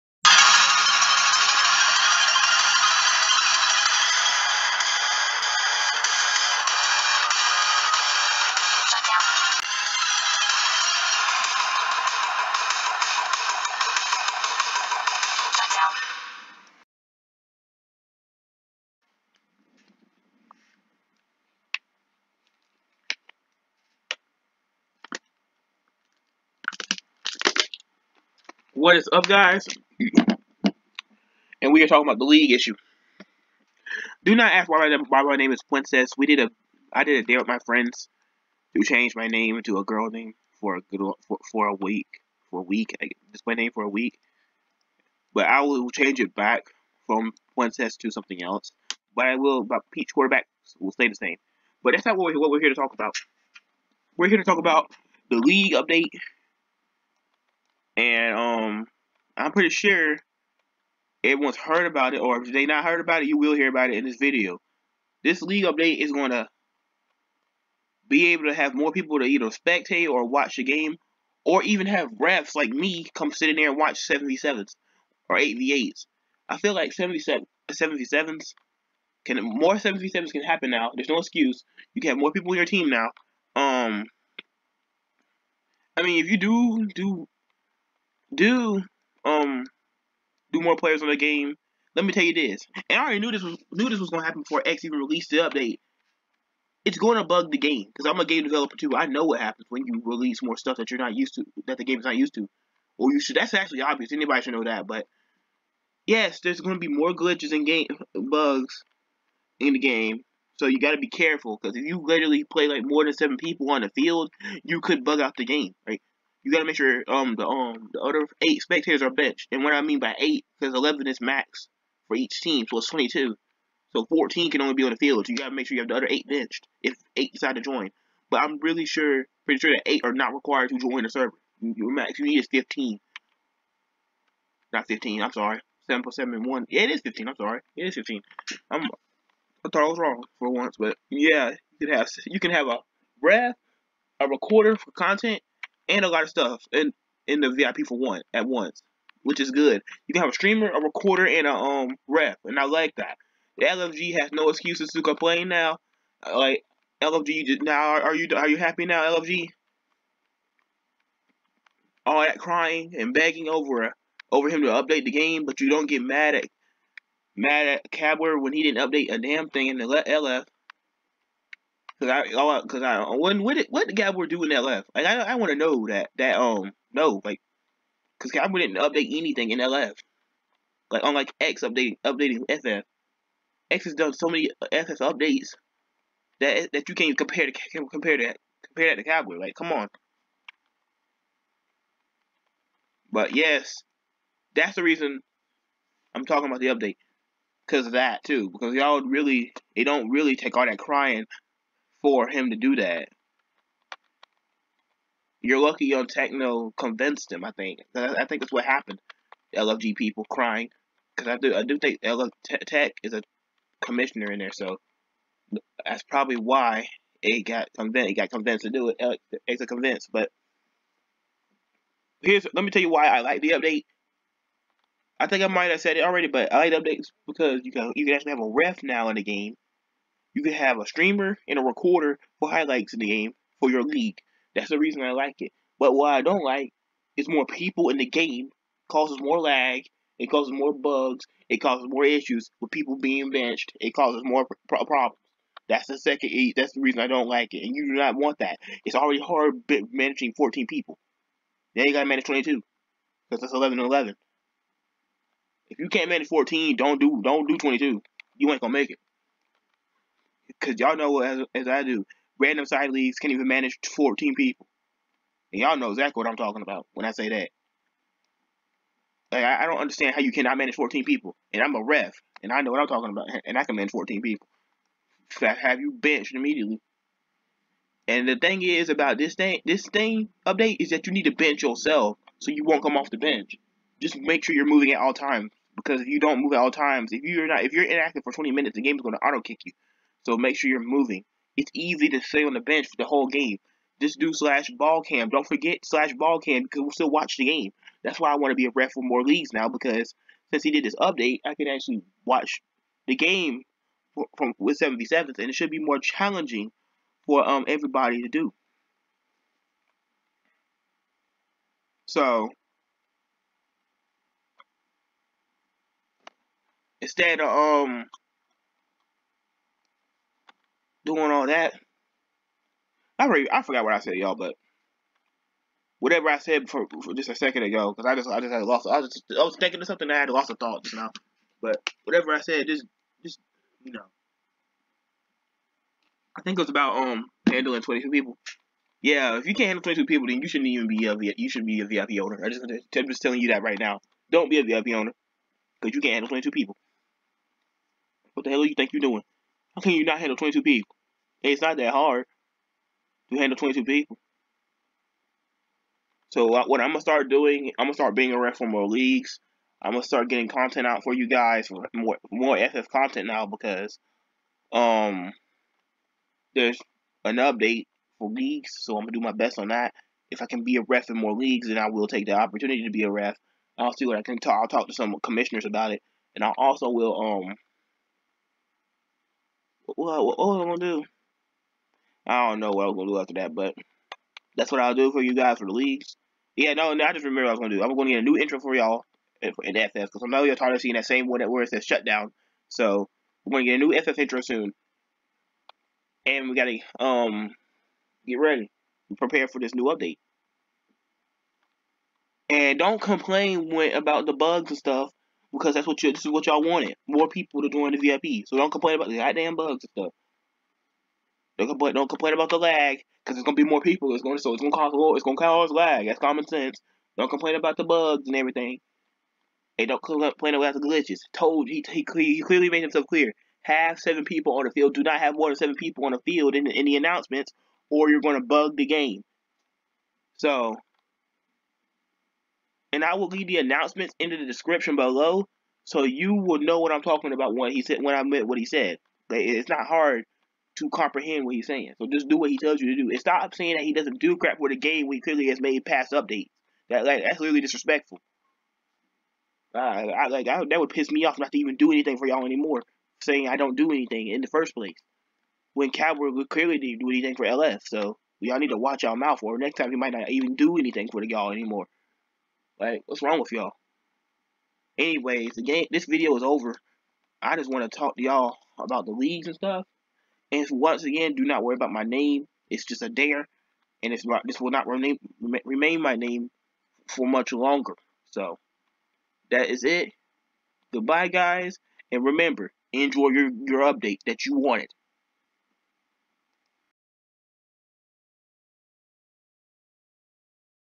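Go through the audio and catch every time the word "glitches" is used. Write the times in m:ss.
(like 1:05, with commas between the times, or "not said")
1:47, 7:00.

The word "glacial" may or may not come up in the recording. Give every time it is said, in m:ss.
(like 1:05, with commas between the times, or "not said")
not said.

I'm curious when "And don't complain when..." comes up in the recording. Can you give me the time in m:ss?
6:42.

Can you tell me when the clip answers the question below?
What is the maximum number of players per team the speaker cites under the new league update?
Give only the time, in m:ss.
2:00.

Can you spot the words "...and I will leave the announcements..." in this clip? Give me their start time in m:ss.
7:12.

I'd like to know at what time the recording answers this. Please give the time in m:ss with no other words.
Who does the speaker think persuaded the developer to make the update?
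3:32.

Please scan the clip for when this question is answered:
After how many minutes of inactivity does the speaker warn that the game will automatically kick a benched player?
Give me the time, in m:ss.
4:48.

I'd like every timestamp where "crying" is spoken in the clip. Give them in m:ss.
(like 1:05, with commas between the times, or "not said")
2:42, 3:20, 3:30.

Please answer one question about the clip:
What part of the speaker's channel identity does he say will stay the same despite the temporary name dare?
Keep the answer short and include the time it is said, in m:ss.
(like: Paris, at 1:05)
peach quarterback, at 0:49.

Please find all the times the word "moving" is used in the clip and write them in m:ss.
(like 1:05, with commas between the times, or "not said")
4:44, 4:50.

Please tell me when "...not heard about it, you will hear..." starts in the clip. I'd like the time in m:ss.
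1:02.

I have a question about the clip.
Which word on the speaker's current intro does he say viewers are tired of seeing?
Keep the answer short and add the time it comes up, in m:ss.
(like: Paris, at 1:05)
shutdown, at 6:31.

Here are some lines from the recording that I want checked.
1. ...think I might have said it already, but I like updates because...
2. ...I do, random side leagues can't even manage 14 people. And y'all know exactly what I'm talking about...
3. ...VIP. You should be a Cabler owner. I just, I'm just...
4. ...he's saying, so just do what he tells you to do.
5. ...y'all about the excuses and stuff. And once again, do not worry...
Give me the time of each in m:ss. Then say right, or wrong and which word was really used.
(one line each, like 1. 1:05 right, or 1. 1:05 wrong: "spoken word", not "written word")
1. 3:45 right
2. 4:21 right
3. 5:41 wrong: "VIP", not "Cabler"
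4. 7:21 right
5. 7:48 wrong: "leagues", not "excuses".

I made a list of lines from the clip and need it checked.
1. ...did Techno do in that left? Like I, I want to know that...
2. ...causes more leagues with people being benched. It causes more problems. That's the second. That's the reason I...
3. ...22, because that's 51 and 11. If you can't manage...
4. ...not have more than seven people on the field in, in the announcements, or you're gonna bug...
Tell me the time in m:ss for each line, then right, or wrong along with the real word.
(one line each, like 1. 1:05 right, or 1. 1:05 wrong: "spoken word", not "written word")
1. 2:53 wrong: "Cabler", not "Techno"
2. 4:01 wrong: "issues", not "leagues"
3. 4:12 wrong: "11", not "51"
4. 7:05 right.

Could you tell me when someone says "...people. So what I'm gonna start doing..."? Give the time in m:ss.
5:53.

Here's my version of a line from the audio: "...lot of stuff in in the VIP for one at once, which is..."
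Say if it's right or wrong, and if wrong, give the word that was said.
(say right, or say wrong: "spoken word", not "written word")
right.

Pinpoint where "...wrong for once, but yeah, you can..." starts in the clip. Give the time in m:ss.
2:19.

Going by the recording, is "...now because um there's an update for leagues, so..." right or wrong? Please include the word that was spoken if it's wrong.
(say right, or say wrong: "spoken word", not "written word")
right.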